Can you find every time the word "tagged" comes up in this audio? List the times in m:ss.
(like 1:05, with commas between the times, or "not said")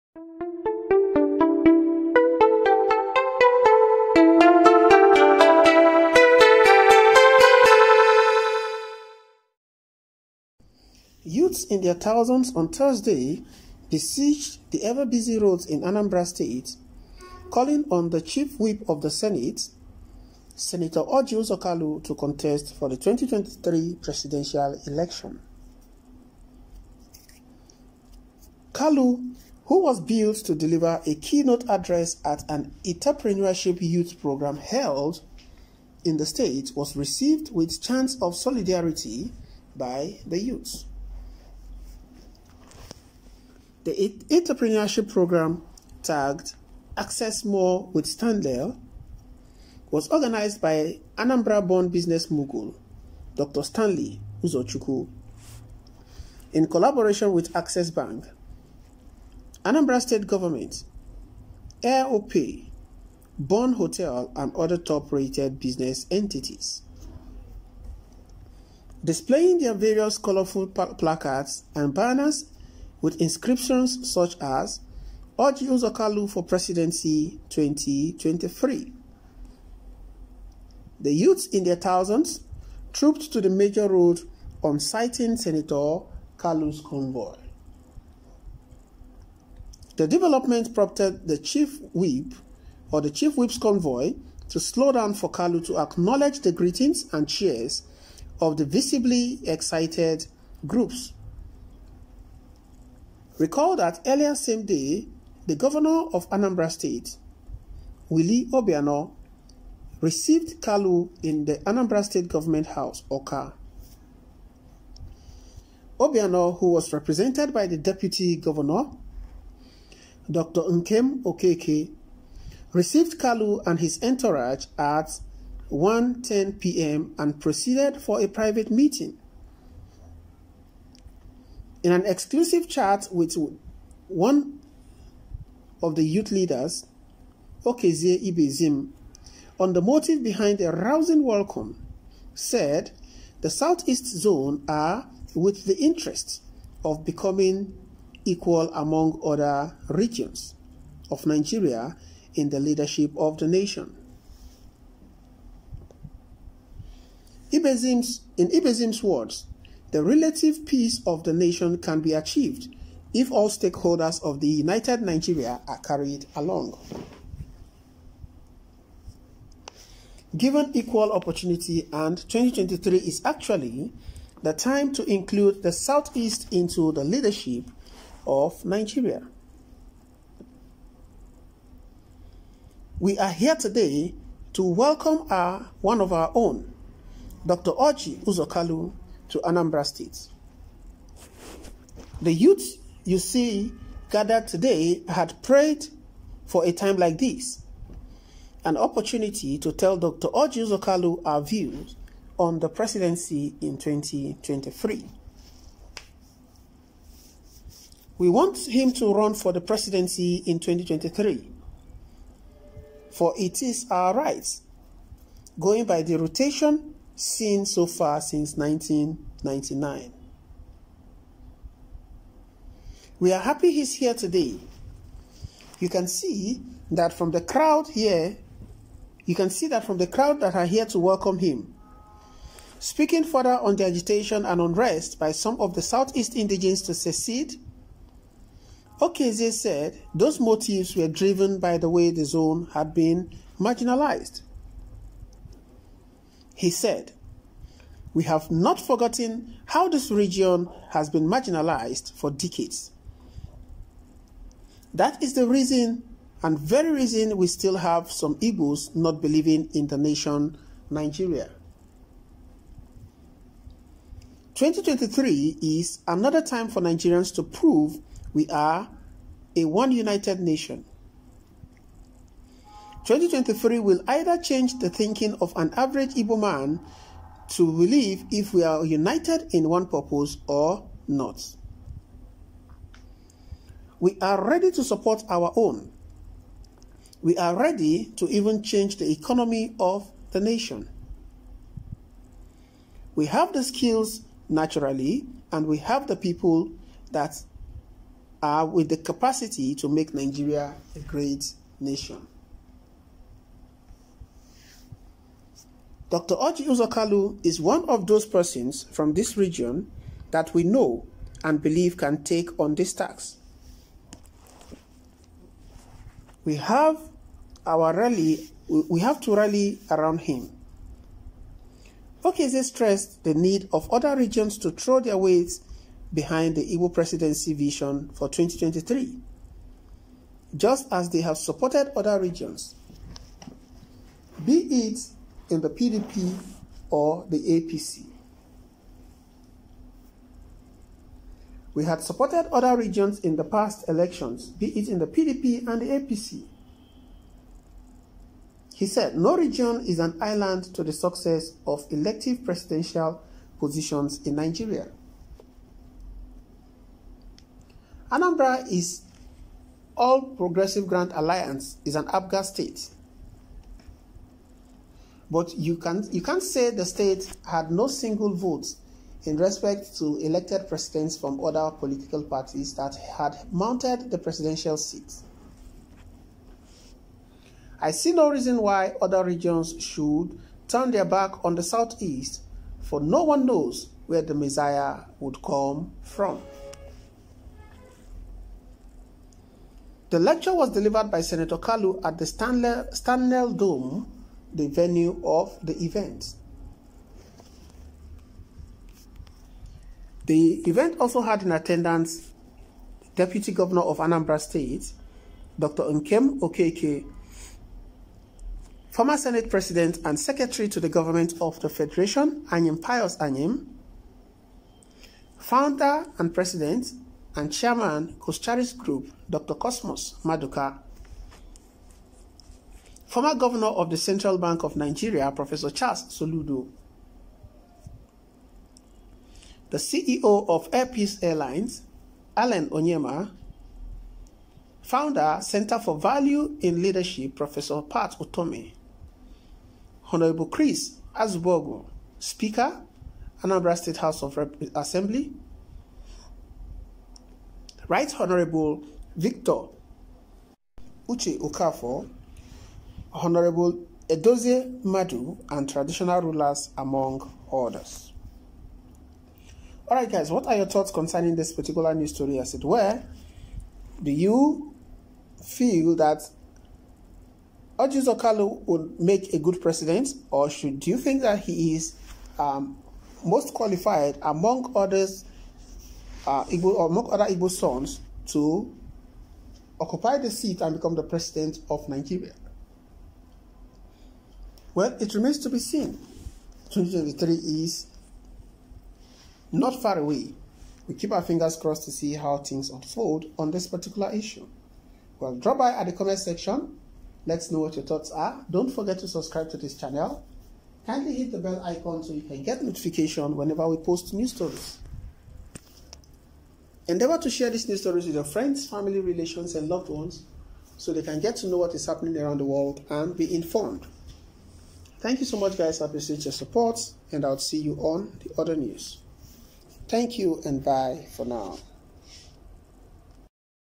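0:46.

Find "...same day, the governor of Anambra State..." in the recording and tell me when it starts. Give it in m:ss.
1:44.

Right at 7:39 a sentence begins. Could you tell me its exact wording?
All right, guys, what are your thoughts concerning this particular news story, as it were?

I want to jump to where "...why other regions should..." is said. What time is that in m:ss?
6:18.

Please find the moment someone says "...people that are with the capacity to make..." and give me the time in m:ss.
4:56.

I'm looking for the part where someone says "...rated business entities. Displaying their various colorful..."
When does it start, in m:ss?
1:05.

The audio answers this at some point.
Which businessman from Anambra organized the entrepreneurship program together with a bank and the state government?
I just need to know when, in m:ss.
0:53.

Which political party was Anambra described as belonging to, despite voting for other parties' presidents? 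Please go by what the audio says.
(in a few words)
All Progressive Grand Alliance.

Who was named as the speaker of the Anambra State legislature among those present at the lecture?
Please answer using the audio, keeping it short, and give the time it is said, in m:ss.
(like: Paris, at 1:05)
Chris Azubogu, at 7:20.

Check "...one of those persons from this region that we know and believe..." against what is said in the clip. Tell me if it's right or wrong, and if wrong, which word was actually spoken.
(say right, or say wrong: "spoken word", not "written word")
right.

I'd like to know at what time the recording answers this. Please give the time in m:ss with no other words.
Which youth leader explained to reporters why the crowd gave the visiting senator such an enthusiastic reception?
2:17.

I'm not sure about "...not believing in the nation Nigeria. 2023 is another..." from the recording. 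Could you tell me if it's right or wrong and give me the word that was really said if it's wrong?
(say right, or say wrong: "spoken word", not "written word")
right.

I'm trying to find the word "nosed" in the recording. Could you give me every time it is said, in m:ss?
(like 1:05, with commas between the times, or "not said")
not said.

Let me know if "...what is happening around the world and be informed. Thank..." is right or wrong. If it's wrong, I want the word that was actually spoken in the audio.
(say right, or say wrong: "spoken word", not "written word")
right.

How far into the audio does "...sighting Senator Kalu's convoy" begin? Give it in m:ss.
1:24.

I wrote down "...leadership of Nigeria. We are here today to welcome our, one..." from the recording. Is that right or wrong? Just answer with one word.
right.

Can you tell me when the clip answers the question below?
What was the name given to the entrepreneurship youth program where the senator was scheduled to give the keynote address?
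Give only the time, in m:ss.
0:46.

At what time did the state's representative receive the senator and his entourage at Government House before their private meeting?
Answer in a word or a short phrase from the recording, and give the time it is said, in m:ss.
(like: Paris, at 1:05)
1:10 p.m., at 2:05.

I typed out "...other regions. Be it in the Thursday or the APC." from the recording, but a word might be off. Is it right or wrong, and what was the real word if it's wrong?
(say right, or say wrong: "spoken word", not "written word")
wrong: "PDP", not "Thursday".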